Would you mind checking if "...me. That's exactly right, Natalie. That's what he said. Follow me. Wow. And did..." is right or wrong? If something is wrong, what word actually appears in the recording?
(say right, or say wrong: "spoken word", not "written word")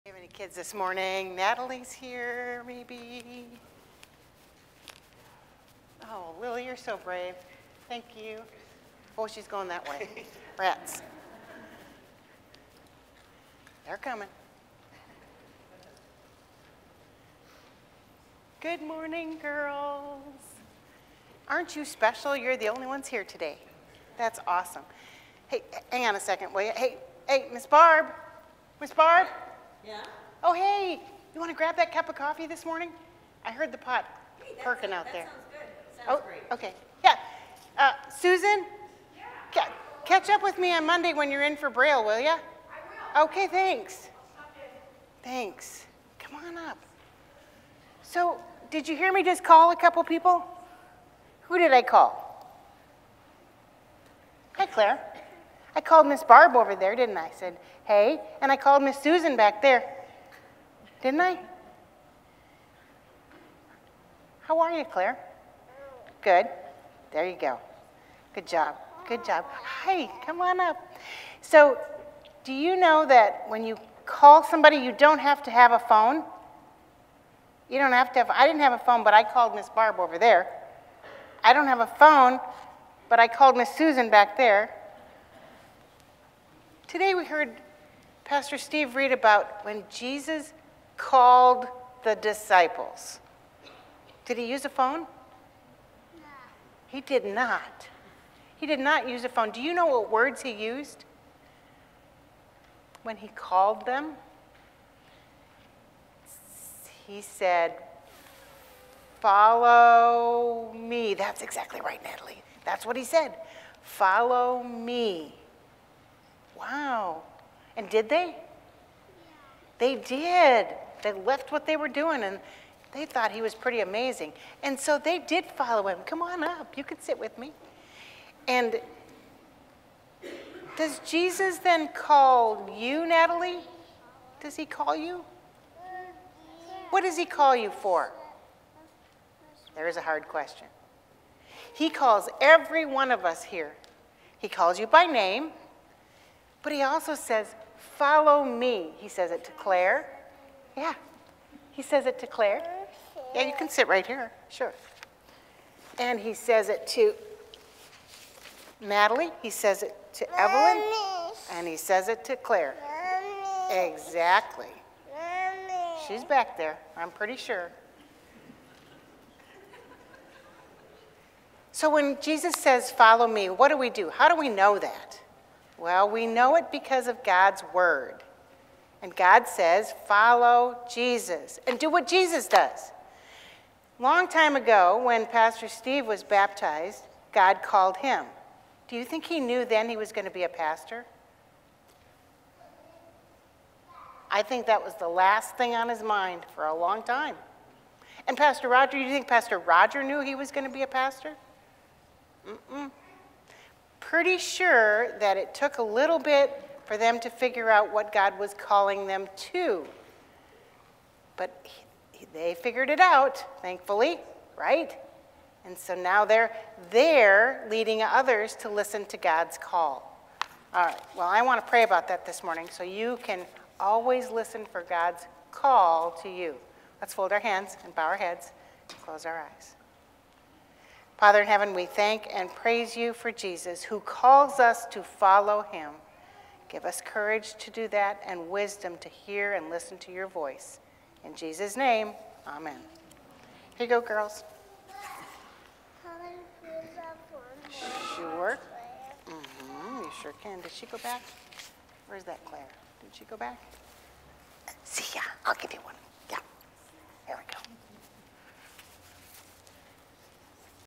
right.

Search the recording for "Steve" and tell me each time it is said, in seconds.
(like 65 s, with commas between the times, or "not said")
88 s, 185 s.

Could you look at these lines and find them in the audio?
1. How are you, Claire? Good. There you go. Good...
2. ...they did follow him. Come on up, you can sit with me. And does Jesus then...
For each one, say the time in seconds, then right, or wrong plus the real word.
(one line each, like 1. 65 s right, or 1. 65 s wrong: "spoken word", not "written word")
1. 64 s right
2. 124 s right.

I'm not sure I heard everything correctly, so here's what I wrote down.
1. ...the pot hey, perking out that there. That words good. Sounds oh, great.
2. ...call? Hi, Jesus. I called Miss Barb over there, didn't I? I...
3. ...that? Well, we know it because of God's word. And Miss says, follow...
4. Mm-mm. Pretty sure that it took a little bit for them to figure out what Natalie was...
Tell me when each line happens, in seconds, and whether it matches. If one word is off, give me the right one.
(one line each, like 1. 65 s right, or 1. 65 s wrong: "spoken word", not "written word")
1. 33 s wrong: "sounds", not "words"
2. 51 s wrong: "Claire", not "Jesus"
3. 174 s wrong: "God", not "Miss"
4. 202 s wrong: "God", not "Natalie".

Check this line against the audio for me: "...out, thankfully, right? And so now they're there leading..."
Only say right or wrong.
right.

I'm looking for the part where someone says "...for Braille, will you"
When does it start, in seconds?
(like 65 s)
41 s.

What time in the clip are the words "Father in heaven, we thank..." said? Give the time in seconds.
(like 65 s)
231 s.